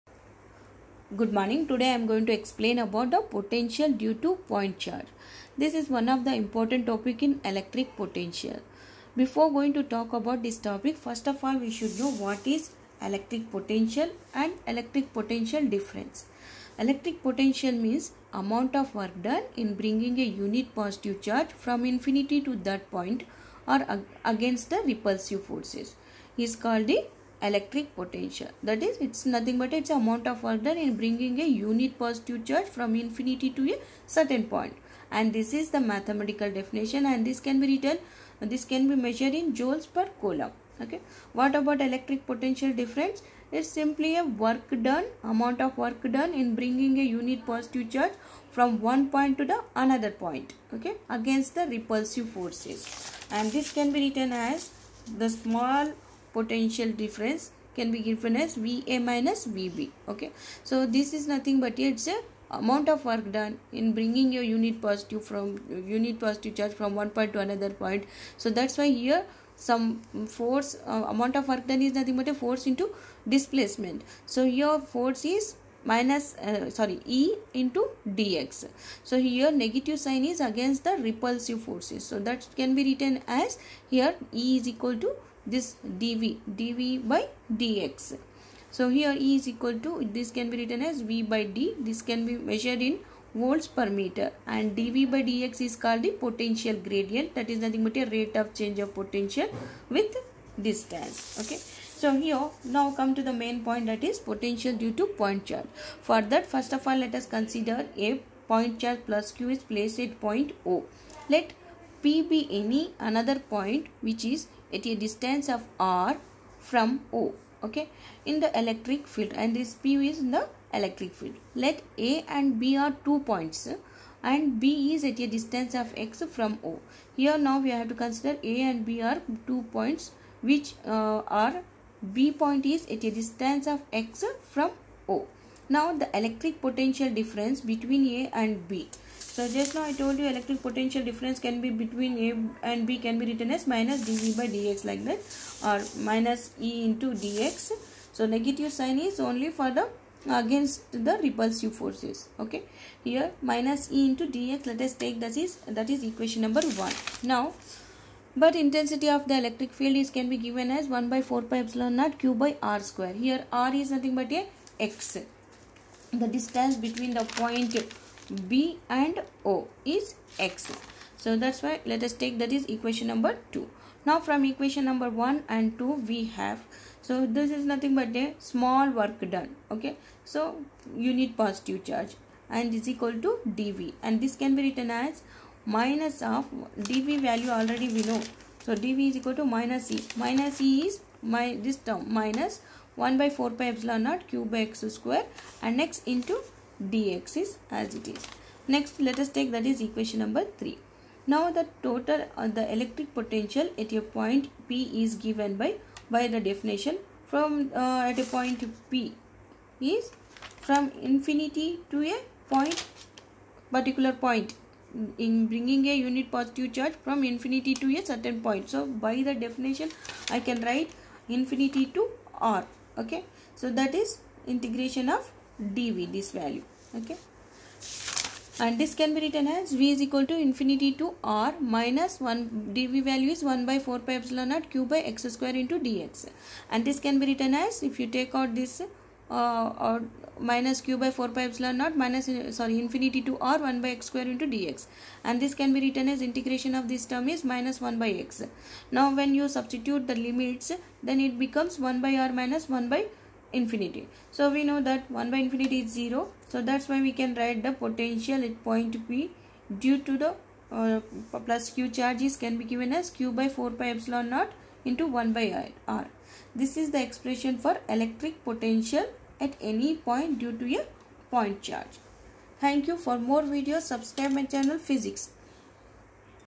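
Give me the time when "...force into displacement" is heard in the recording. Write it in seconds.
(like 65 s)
72 s.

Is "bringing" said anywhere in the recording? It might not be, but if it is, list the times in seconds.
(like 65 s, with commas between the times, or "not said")
19 s, 30 s, 46 s, 63 s, 215 s.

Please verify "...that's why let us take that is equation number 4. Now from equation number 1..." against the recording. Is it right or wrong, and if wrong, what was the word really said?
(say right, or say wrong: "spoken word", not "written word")
wrong: "2", not "4".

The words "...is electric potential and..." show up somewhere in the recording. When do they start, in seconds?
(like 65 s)
12 s.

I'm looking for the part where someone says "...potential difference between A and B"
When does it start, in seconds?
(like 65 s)
136 s.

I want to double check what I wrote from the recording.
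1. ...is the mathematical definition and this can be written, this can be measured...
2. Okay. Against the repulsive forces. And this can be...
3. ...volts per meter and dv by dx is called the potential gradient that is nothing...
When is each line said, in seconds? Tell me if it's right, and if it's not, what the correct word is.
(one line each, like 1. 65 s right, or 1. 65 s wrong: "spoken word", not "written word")
1. 35 s right
2. 50 s right
3. 93 s right.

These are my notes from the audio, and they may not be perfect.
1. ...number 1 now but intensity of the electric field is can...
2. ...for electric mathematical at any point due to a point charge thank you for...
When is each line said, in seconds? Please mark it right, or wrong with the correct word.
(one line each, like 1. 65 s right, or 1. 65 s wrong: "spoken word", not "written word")
1. 156 s right
2. 267 s wrong: "potential", not "mathematical".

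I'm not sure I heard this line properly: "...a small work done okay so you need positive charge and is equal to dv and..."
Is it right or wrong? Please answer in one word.
right.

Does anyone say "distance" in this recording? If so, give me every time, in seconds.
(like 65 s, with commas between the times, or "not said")
100 s, 114 s, 125 s, 133 s, 166 s.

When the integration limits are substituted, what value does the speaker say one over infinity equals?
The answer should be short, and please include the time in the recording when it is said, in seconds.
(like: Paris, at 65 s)
0, at 255 s.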